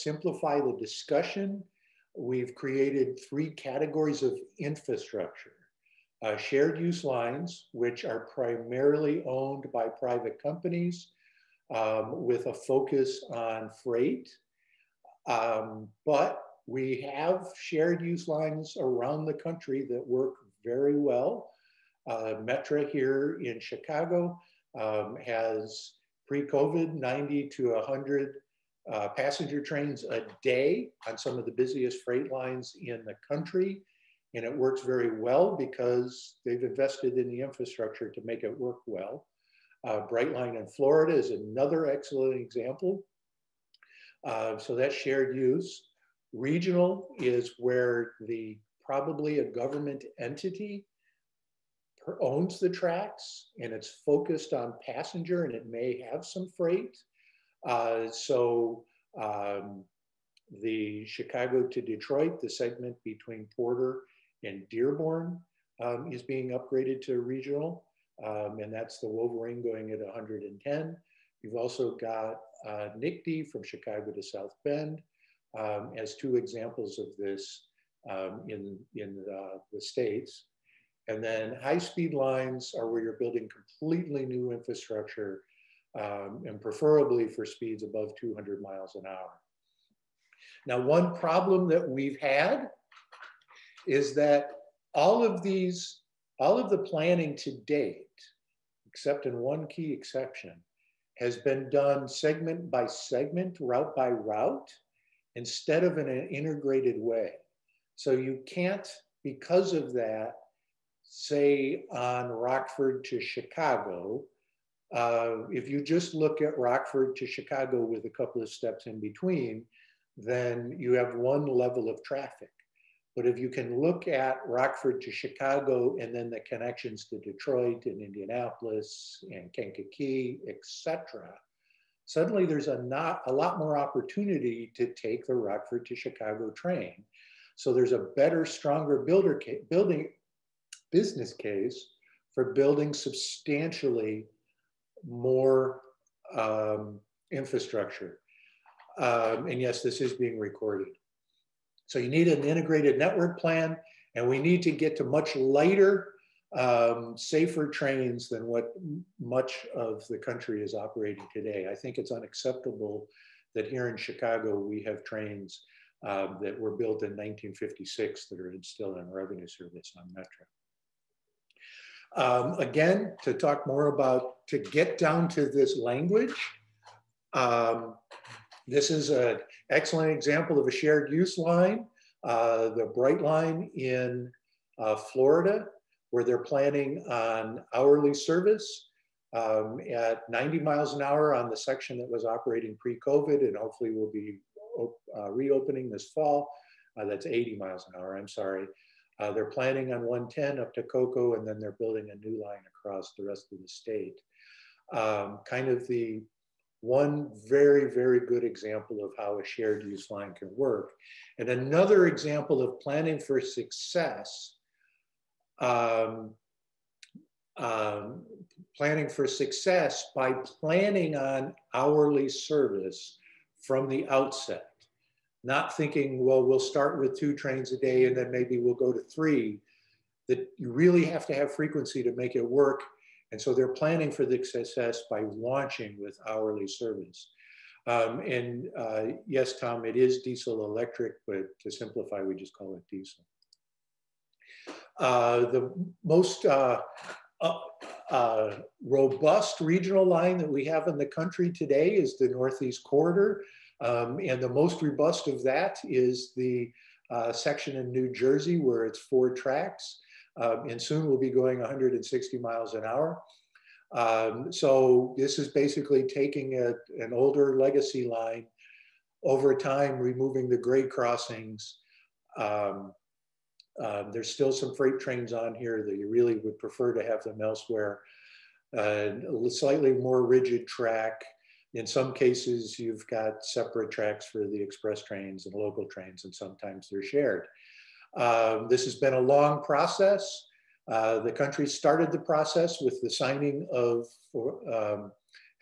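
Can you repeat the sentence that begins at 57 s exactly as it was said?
Uh, so um, the Chicago to Detroit, the segment between Porter and Dearborn um, is being upgraded to regional.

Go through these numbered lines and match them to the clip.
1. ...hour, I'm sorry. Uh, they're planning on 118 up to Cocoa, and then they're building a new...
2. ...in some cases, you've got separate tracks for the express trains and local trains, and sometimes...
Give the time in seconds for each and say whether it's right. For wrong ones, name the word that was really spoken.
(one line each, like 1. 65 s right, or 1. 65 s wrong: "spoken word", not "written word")
1. 197 s wrong: "110", not "118"
2. 281 s right.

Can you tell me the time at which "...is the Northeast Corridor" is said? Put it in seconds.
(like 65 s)
251 s.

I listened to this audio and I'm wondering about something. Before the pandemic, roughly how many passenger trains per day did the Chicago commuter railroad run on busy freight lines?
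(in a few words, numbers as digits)
90 to 100.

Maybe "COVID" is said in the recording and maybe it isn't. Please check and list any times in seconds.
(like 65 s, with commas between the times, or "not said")
26 s, 192 s.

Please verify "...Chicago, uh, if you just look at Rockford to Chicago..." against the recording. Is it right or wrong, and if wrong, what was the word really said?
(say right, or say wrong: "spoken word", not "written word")
right.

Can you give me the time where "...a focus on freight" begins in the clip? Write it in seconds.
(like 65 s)
12 s.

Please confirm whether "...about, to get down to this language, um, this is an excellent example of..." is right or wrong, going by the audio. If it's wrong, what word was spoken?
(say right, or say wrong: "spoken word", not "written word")
right.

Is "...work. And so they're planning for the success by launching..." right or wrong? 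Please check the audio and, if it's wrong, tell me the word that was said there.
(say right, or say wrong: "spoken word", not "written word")
right.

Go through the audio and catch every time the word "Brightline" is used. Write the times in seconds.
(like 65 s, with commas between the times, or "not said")
40 s, 182 s.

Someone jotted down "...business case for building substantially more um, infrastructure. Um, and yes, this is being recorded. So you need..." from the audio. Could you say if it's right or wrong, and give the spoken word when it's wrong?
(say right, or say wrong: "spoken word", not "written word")
right.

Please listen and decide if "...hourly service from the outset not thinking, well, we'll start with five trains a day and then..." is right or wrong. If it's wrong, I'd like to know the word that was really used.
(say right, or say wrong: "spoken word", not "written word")
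wrong: "two", not "five".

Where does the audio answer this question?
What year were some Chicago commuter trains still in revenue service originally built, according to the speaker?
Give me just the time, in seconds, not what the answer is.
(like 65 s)
167 s.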